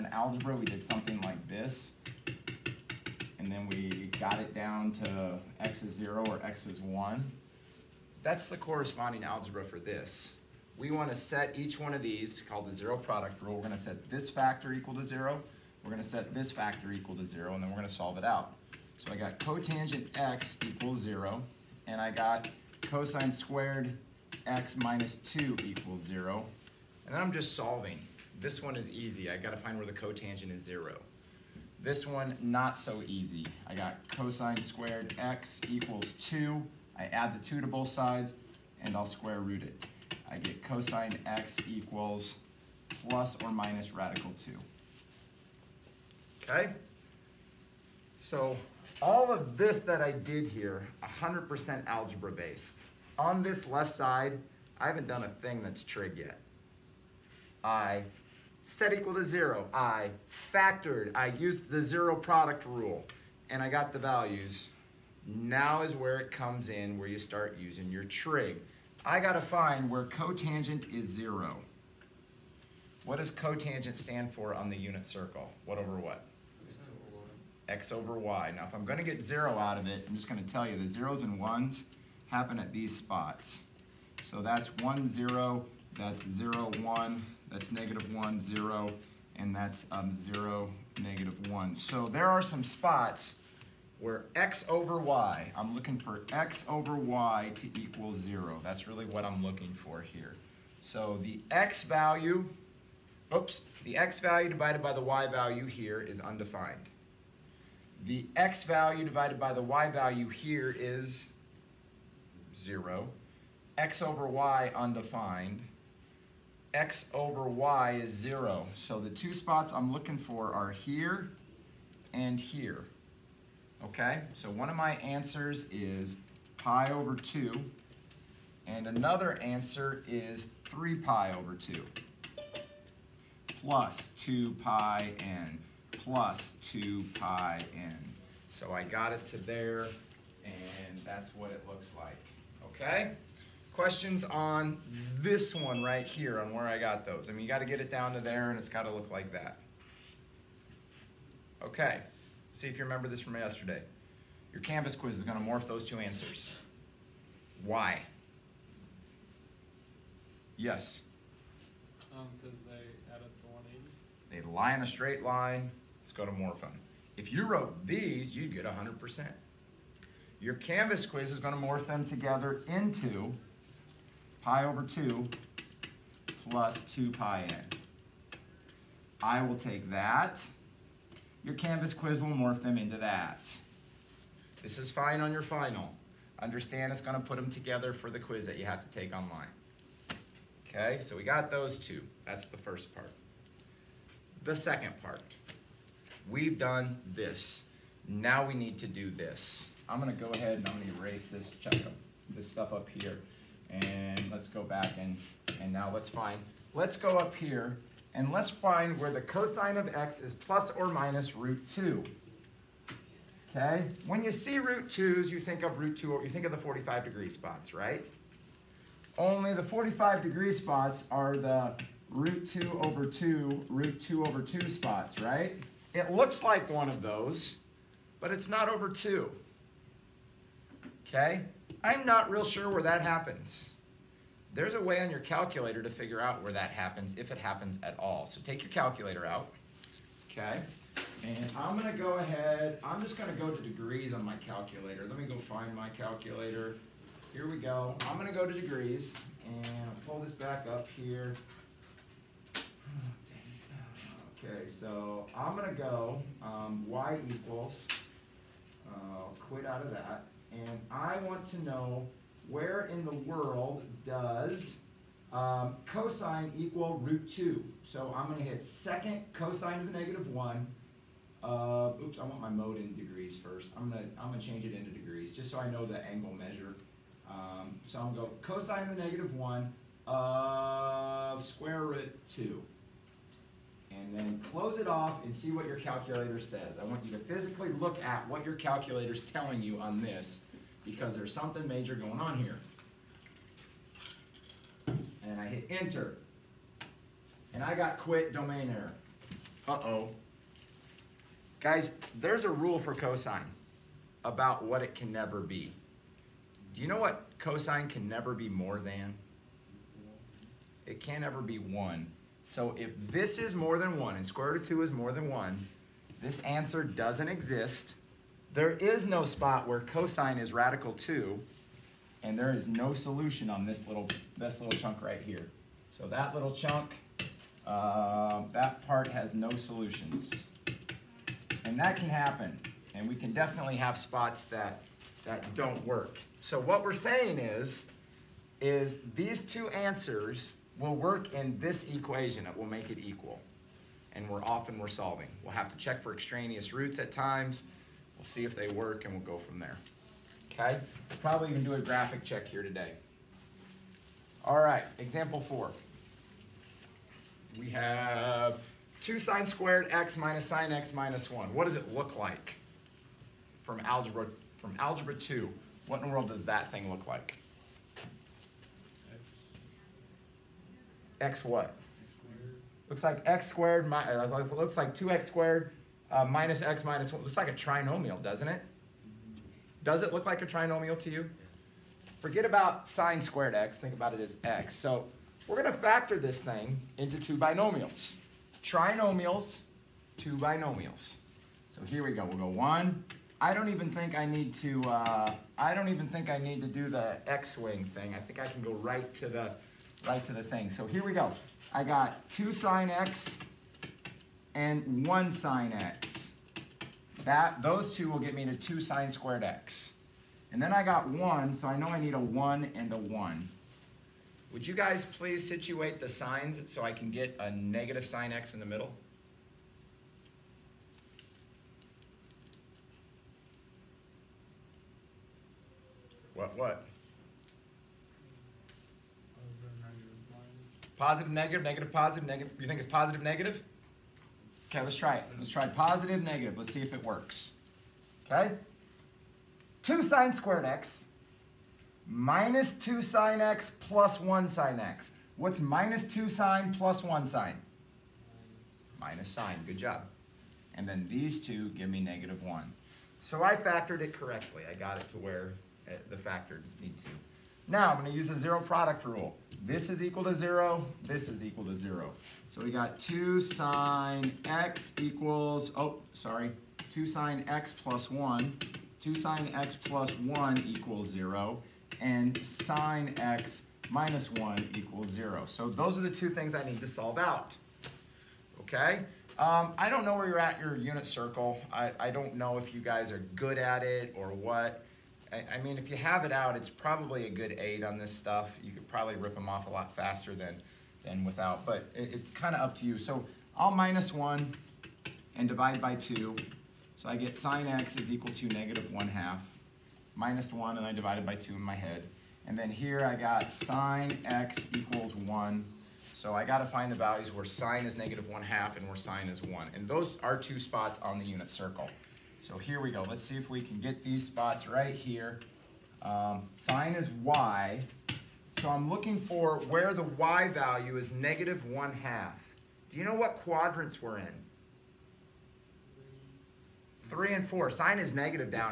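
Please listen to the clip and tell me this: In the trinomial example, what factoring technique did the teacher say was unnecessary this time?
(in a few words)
the x-wing.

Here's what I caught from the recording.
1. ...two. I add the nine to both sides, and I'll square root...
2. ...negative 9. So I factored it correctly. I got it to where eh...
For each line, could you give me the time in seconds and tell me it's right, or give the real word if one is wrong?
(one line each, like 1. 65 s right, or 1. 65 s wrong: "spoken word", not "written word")
1. 36 s wrong: "two", not "nine"
2. 451 s wrong: "1", not "9".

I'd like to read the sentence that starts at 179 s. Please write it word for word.
I will take that your Canvas quiz will morph them into that.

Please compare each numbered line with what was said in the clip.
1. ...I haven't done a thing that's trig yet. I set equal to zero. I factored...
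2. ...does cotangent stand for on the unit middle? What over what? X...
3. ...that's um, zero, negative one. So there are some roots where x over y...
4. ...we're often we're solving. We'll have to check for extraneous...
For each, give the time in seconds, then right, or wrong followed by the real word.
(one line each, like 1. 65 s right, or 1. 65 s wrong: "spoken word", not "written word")
1. 54 s right
2. 73 s wrong: "circle", not "middle"
3. 89 s wrong: "spots", not "roots"
4. 344 s right.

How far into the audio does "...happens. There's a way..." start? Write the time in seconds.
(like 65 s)
233 s.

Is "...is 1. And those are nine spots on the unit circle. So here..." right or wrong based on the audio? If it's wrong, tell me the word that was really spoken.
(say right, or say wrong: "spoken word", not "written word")
wrong: "two", not "nine".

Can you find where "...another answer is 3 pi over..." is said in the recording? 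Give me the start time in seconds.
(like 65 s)
128 s.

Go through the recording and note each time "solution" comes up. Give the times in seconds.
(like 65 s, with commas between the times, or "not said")
322 s, 329 s.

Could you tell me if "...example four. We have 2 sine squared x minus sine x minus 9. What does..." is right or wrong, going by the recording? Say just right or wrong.
wrong.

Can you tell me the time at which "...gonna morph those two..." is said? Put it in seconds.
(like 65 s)
155 s.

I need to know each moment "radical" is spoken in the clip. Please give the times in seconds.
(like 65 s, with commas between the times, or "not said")
43 s, 320 s.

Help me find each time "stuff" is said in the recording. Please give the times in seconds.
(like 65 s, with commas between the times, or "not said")
202 s, 488 s.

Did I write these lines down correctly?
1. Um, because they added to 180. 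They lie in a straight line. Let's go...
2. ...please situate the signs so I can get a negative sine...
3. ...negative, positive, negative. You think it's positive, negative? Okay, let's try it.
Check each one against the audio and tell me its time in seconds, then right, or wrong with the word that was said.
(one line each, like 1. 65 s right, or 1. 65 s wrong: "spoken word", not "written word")
1. 162 s right
2. 415 s right
3. 431 s right.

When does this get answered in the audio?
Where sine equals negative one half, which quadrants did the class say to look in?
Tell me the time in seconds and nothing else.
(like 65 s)
527 s.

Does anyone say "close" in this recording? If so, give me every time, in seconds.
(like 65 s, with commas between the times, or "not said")
284 s.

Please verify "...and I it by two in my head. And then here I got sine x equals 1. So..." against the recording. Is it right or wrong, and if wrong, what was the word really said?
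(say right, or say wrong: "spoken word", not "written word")
right.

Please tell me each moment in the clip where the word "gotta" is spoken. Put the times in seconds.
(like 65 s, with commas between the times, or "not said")
69 s.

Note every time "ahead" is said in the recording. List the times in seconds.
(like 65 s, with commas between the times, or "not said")
200 s, 242 s.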